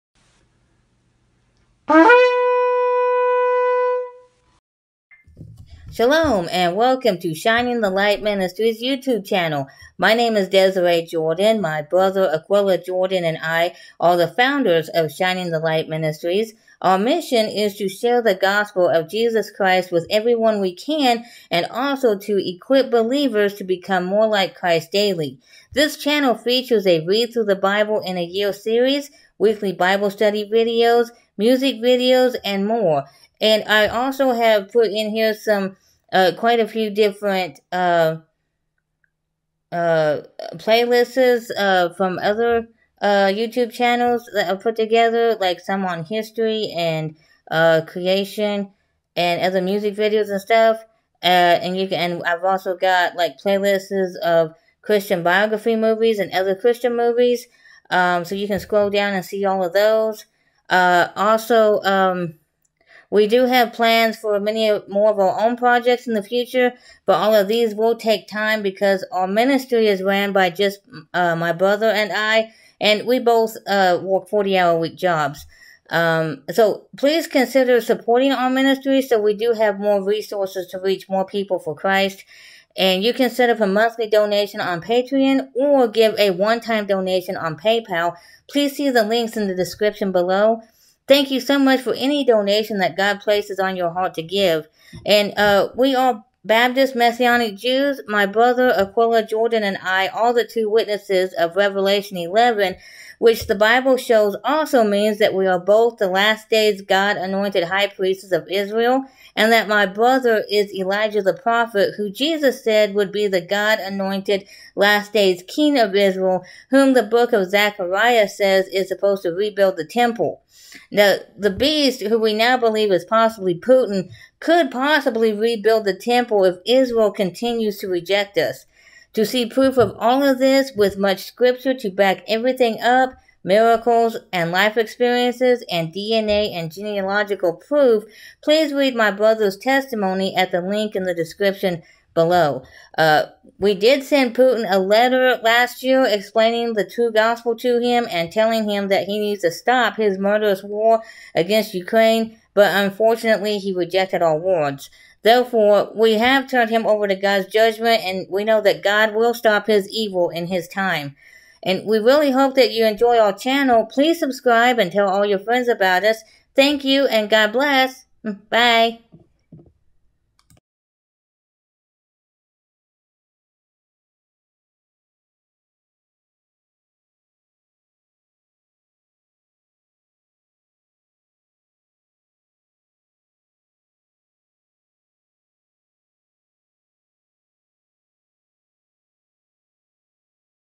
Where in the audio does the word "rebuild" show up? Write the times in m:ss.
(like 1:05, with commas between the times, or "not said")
1:59, 2:05.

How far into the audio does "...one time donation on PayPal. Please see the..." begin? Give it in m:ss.
1:26.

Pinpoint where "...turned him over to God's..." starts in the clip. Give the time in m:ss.
2:36.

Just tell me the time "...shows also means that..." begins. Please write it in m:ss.
1:43.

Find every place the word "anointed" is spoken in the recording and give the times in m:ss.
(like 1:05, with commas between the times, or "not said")
1:47, 1:53.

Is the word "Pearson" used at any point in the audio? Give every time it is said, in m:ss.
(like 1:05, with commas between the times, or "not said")
not said.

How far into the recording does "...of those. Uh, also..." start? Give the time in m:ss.
0:59.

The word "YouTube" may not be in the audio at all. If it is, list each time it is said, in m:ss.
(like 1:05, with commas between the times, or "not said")
0:08, 0:43.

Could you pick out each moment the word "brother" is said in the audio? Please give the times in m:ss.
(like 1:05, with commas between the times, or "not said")
0:11, 1:11, 1:38, 1:49, 2:19.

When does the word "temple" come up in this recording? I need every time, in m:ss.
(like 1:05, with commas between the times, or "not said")
1:59, 2:05.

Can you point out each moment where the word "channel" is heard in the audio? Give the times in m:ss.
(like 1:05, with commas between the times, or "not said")
0:09, 0:25, 0:43, 2:43.